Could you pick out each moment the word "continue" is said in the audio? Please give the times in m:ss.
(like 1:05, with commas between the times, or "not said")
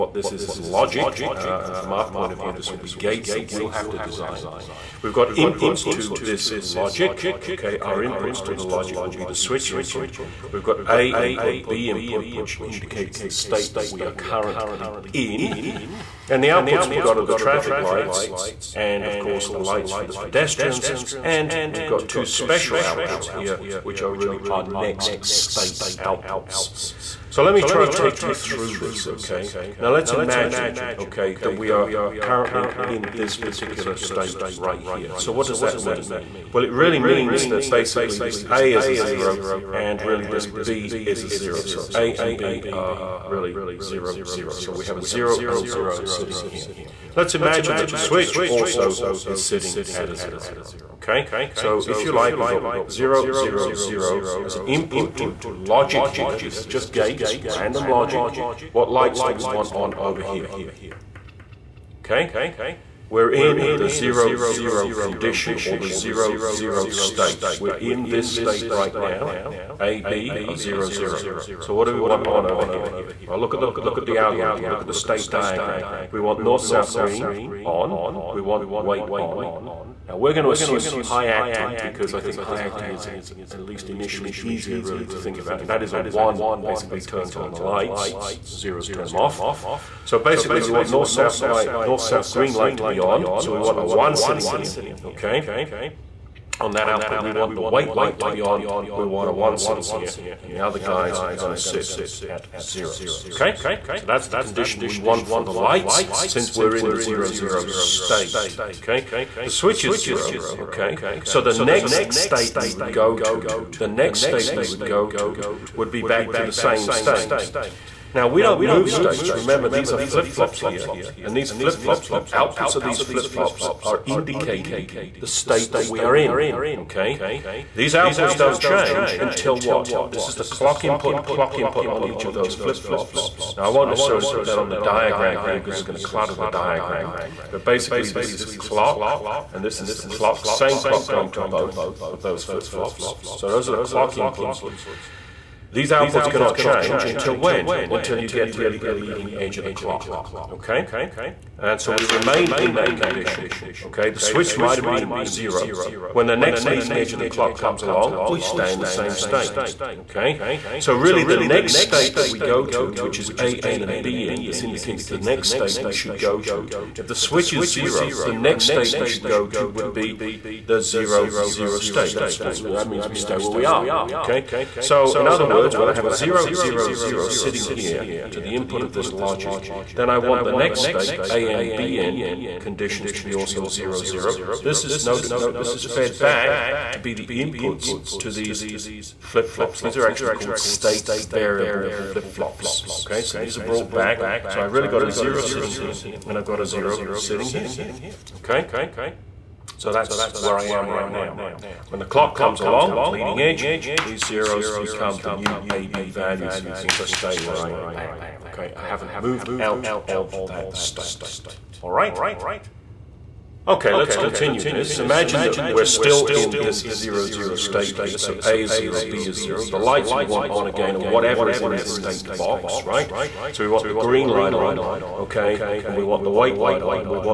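3:34.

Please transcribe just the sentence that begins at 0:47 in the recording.
Let's imagine that the switch also is sitting at a zero.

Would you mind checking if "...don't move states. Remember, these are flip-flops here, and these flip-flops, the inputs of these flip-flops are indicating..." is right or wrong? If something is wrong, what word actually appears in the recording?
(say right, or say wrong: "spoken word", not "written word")
wrong: "outputs", not "inputs".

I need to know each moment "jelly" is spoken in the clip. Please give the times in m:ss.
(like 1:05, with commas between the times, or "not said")
not said.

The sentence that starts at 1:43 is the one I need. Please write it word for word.
So that's the condition we want for the lights since we're in the zero zero state, okay?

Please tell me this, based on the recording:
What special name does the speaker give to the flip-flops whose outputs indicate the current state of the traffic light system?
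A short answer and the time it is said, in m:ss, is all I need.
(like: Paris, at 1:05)
State variable flip-flops, at 3:10.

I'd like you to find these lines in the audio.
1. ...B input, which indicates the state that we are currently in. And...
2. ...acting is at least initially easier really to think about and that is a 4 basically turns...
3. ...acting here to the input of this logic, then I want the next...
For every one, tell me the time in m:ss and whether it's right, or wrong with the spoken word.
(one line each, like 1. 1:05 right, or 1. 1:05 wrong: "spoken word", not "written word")
1. 0:11 right
2. 1:22 wrong: "1", not "4"
3. 2:57 wrong: "sitting", not "acting".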